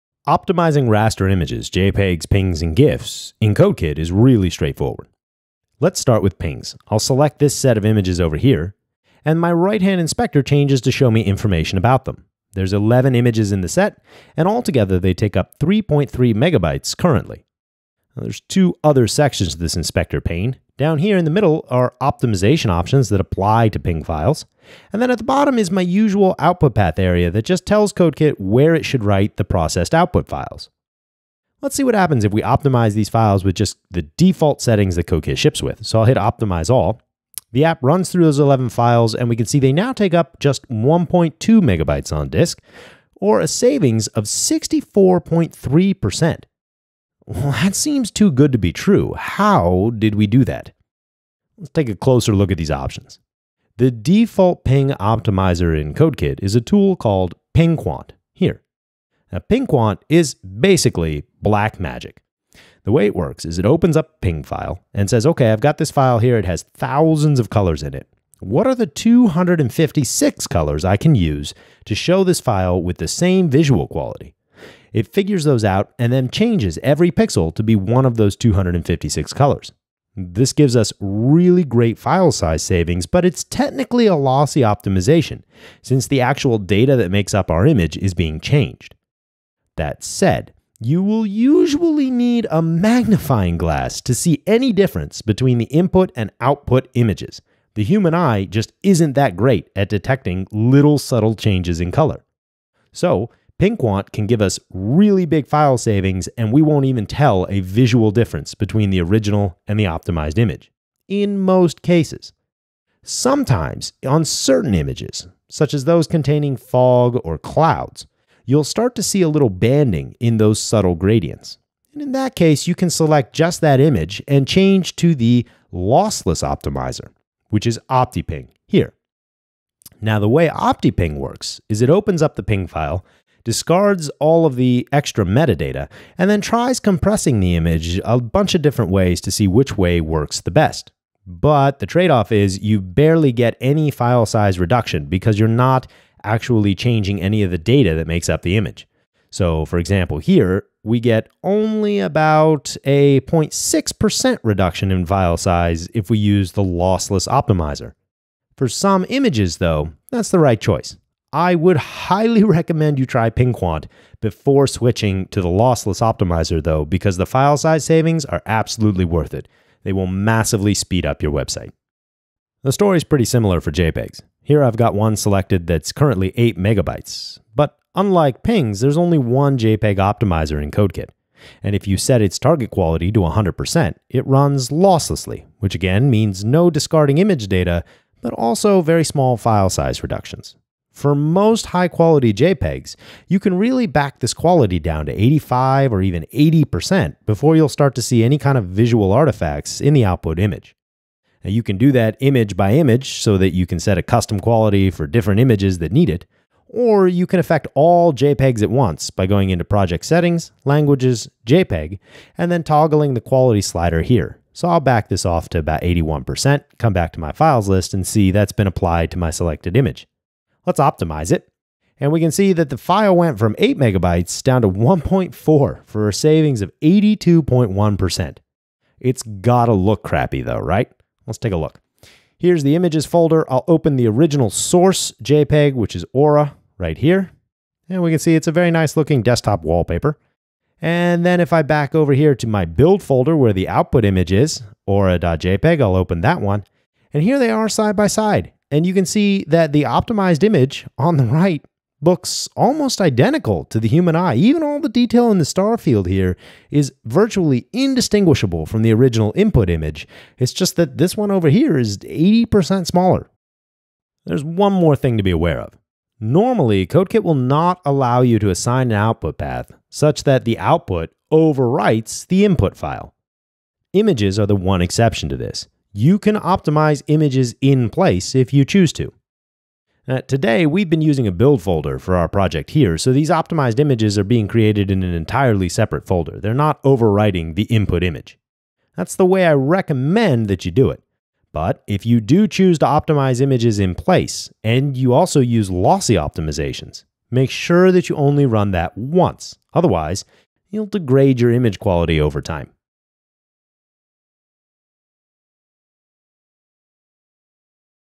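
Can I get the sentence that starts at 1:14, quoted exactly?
It figures those out and then changes every pixel to be one of those 256 colors.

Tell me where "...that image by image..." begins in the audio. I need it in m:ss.
3:21.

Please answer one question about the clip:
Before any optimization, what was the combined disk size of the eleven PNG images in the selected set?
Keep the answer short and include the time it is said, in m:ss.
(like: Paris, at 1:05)
3.3 megabytes, at 0:15.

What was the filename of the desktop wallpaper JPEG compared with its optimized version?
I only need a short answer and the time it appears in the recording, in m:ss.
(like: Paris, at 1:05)
Aura, at 3:56.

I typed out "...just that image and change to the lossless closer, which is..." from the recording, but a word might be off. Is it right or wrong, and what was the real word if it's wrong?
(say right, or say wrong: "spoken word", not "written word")
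wrong: "optimizer", not "closer".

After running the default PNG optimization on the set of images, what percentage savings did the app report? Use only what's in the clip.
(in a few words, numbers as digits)
64.3%.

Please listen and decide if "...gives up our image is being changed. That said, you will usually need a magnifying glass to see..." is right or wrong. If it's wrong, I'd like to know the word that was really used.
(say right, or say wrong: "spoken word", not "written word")
wrong: "makes", not "gives".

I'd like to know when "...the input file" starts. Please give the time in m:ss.
4:32.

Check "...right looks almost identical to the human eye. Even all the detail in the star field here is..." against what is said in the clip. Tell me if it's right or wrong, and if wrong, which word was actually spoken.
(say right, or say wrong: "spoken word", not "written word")
right.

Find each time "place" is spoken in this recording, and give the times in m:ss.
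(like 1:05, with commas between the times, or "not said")
4:37, 4:53.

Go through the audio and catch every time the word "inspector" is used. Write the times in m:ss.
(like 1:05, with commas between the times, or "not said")
0:09, 0:19.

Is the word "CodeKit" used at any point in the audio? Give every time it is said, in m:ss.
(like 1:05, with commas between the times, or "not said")
0:03, 0:27, 0:35, 0:55, 3:00, 4:26.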